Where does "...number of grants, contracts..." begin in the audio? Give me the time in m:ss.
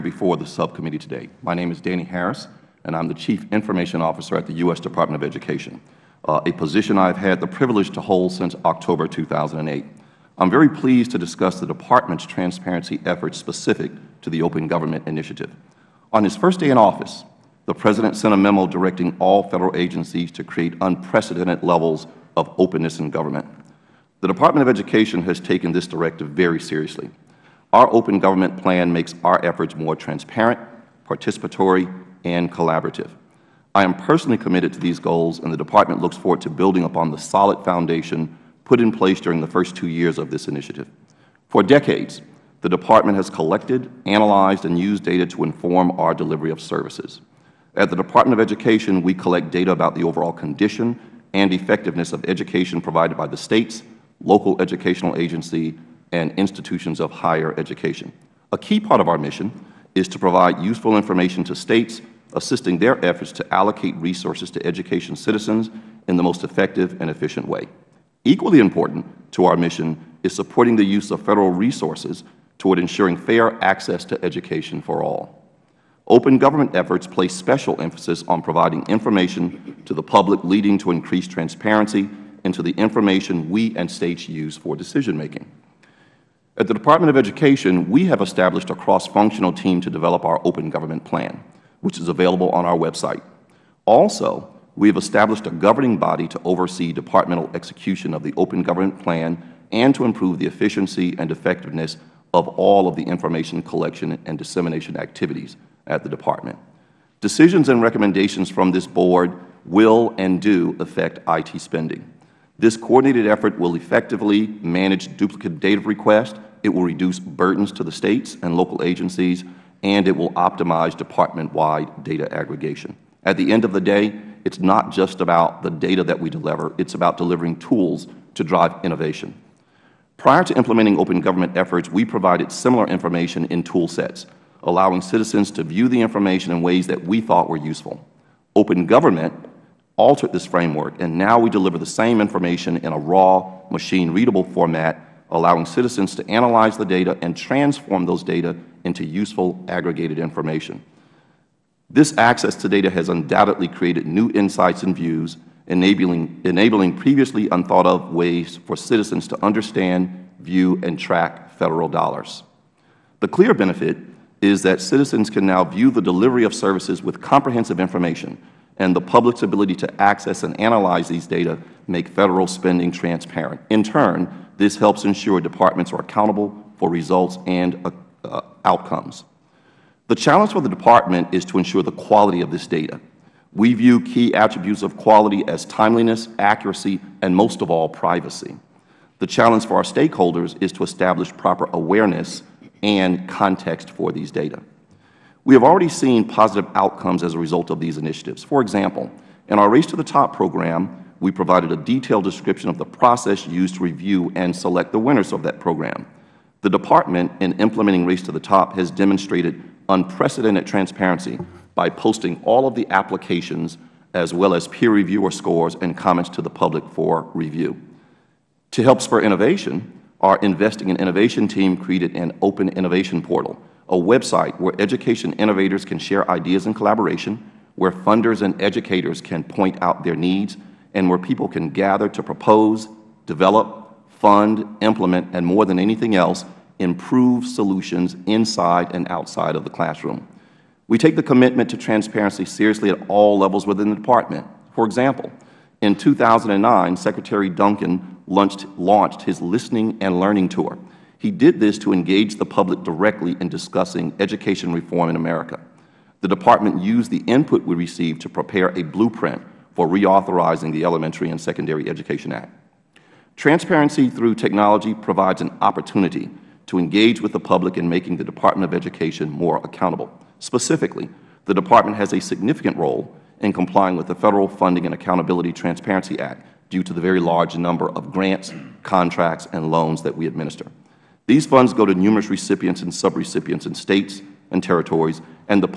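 4:37.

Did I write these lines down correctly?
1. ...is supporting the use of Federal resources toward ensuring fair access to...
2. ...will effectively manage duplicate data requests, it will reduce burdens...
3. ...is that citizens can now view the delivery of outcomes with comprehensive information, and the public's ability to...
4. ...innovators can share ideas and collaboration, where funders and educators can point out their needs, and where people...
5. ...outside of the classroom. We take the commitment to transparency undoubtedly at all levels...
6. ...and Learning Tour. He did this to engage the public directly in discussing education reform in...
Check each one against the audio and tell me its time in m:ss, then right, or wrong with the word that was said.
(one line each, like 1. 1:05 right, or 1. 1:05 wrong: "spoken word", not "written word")
1. 1:10 right
2. 1:53 right
3. 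2:44 wrong: "services", not "outcomes"
4. 3:45 right
5. 3:59 wrong: "seriously", not "undoubtedly"
6. 4:09 right.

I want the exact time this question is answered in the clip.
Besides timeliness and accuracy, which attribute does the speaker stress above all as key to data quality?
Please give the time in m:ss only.
3:07.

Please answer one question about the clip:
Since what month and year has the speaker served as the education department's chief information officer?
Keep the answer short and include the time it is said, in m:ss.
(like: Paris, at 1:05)
October 2008, at 0:08.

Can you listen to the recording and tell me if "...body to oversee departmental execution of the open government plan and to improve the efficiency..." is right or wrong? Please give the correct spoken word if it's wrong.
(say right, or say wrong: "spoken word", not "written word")
right.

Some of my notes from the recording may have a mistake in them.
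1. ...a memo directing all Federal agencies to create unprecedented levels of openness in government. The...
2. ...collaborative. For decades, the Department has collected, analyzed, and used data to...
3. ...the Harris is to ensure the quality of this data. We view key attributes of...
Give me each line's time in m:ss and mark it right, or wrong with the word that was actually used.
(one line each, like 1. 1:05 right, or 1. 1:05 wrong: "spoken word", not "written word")
1. 0:18 right
2. 0:40 wrong: "initiative", not "collaborative"
3. 3:00 wrong: "Department", not "Harris".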